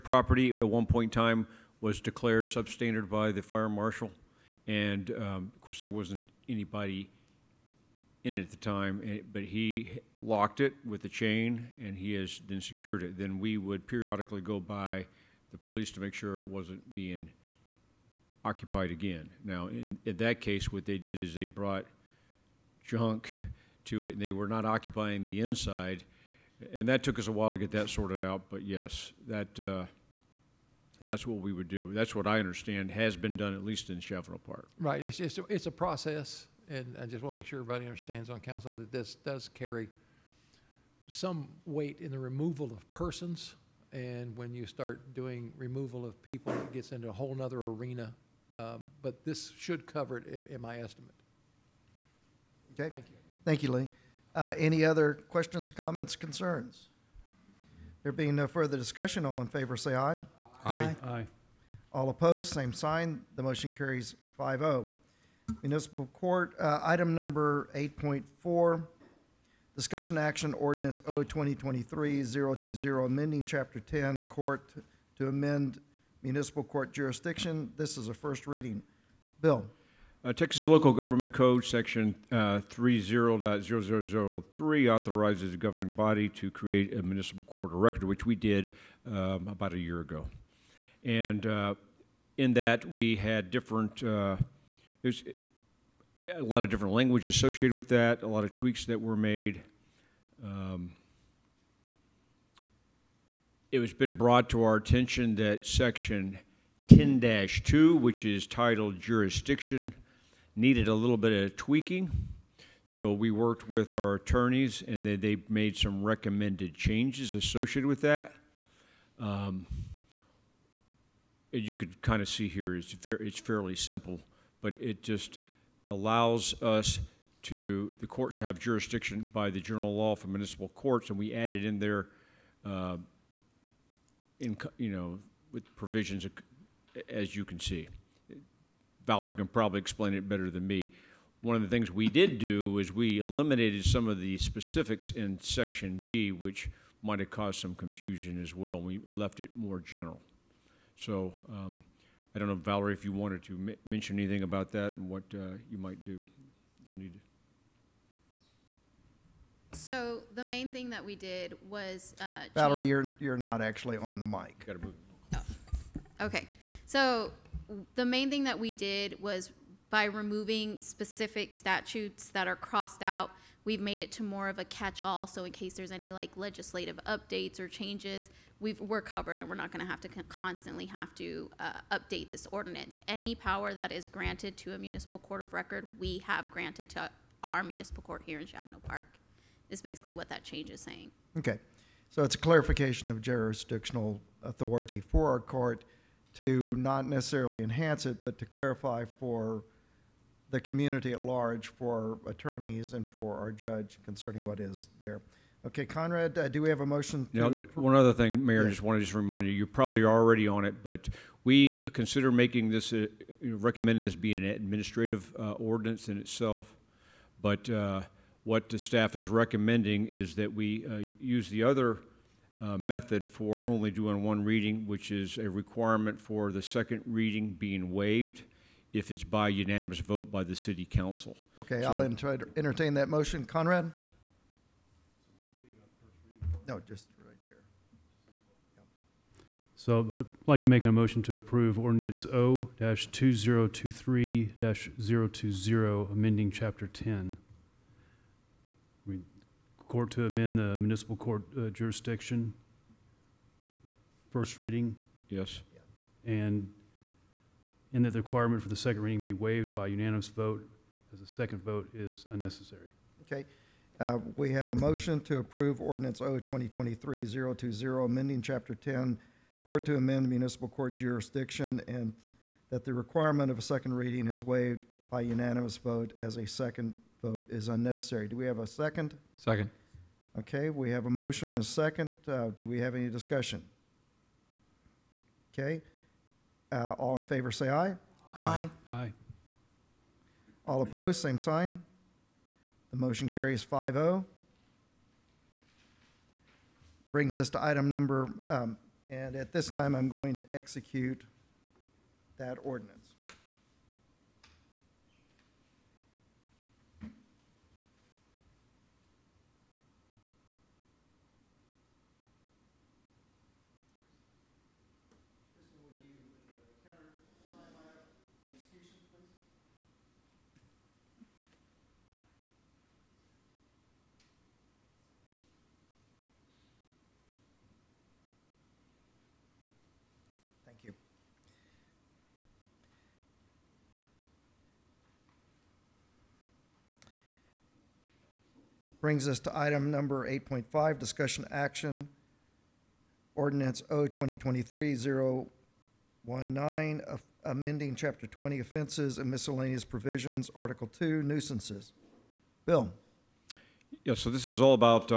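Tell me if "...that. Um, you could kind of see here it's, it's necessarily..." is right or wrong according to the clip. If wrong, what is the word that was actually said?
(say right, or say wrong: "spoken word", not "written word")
wrong: "fairly", not "necessarily".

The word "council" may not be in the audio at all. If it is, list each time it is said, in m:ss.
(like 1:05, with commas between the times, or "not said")
0:38, 3:50.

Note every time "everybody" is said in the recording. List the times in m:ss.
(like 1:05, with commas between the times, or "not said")
0:37.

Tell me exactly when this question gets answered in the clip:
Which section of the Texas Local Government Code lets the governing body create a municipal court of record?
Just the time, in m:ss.
1:22.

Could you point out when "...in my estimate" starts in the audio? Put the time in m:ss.
0:50.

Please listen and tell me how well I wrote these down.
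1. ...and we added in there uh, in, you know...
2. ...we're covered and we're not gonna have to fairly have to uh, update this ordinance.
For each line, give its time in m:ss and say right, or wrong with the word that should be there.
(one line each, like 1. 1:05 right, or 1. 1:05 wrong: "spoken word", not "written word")
1. 2:11 right
2. 2:58 wrong: "constantly", not "fairly".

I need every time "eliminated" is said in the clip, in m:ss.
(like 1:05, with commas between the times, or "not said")
2:23.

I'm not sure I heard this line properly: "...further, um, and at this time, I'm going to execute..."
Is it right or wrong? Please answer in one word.
wrong.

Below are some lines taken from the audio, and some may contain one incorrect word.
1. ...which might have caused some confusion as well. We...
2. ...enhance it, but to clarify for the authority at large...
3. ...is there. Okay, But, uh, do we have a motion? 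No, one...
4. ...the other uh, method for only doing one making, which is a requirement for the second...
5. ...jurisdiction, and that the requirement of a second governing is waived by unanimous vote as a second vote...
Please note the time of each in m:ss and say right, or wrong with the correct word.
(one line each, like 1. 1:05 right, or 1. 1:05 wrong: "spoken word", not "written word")
1. 2:26 right
2. 3:17 wrong: "community", not "authority"
3. 3:24 wrong: "Conrad", not "But"
4. 3:41 wrong: "reading", not "making"
5. 4:30 wrong: "reading", not "governing".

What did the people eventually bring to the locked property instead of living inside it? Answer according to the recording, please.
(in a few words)
Junk.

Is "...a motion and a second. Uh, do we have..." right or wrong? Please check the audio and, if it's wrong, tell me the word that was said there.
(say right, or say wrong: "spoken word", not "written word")
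right.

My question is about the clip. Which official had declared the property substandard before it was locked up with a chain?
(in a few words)
Fire marshal.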